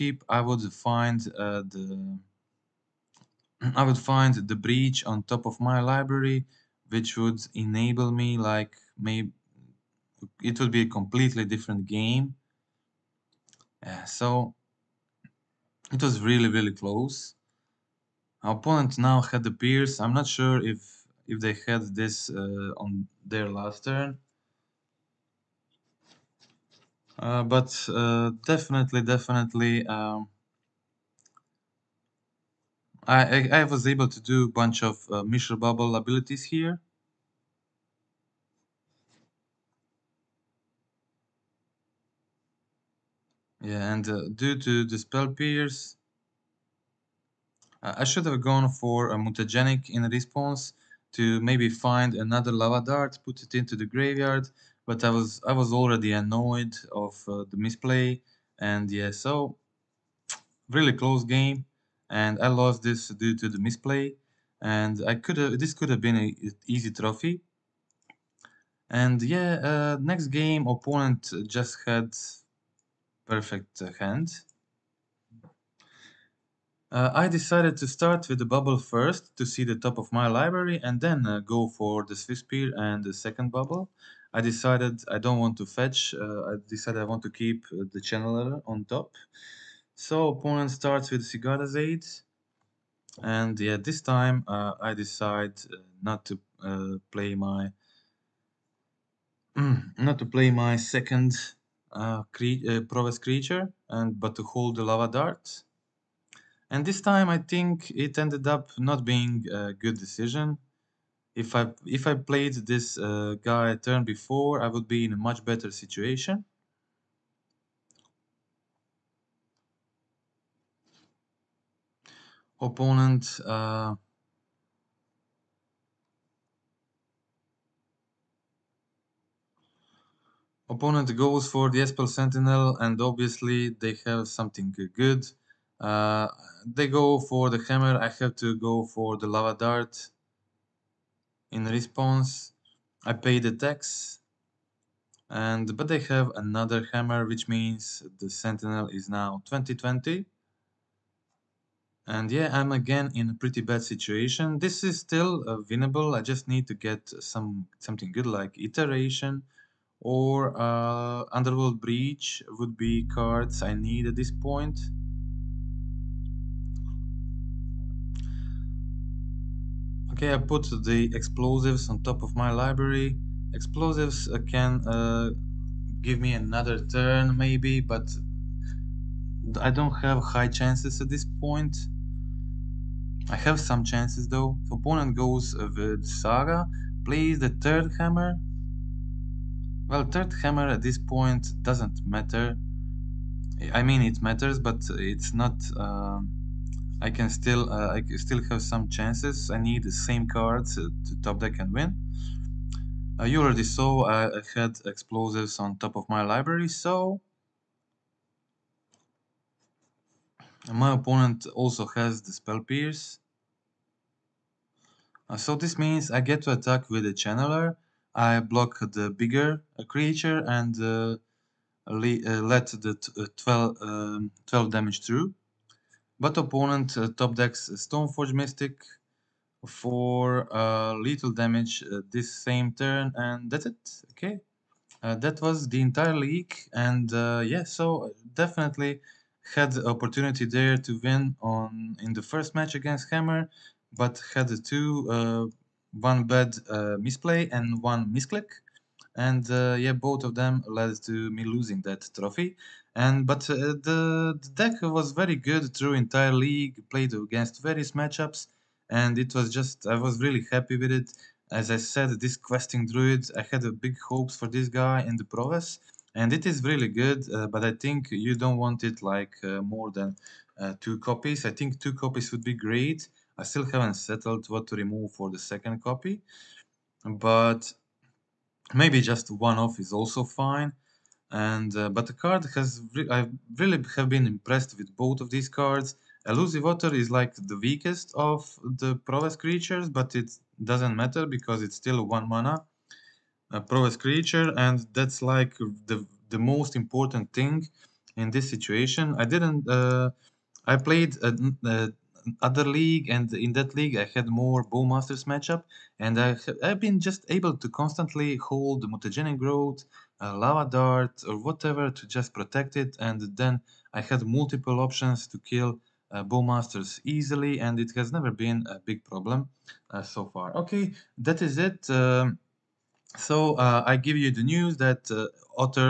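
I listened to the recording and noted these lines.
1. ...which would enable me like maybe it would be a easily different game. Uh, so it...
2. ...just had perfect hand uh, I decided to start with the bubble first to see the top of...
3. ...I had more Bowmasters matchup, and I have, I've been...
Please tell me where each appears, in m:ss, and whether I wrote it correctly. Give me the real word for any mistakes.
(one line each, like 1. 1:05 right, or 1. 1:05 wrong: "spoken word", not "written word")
1. 0:06 wrong: "completely", not "easily"
2. 1:11 right
3. 5:03 right.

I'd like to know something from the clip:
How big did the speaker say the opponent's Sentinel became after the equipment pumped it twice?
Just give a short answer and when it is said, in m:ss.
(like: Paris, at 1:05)
20/20, at 2:29.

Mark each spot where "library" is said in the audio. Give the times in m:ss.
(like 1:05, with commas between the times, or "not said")
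0:05, 1:20, 2:52, 3:26.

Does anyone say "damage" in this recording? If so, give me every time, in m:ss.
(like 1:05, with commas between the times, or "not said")
3:44, 3:51.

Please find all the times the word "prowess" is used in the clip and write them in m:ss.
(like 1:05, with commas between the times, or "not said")
4:25, 4:49, 4:53.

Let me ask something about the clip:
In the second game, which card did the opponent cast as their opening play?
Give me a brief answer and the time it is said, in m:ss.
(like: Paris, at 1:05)
Sigarda's Aid, at 1:31.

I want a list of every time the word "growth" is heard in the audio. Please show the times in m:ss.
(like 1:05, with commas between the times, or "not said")
5:09.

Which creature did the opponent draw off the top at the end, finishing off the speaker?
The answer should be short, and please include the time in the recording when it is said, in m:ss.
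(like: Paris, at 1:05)
Stoneforge Mystic, at 3:47.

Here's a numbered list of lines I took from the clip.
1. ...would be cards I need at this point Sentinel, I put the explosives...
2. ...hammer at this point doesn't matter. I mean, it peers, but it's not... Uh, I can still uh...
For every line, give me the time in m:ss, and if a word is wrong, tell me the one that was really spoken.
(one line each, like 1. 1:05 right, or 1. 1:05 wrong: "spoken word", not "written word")
1. 2:42 wrong: "Okay", not "Sentinel"
2. 3:10 wrong: "matters", not "peers".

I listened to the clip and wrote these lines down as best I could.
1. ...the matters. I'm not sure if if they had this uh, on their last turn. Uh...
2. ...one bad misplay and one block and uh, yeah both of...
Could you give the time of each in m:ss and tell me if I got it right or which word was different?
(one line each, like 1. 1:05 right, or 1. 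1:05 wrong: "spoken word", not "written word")
1. 0:19 wrong: "peers", not "matters"
2. 4:05 wrong: "misclick", not "block".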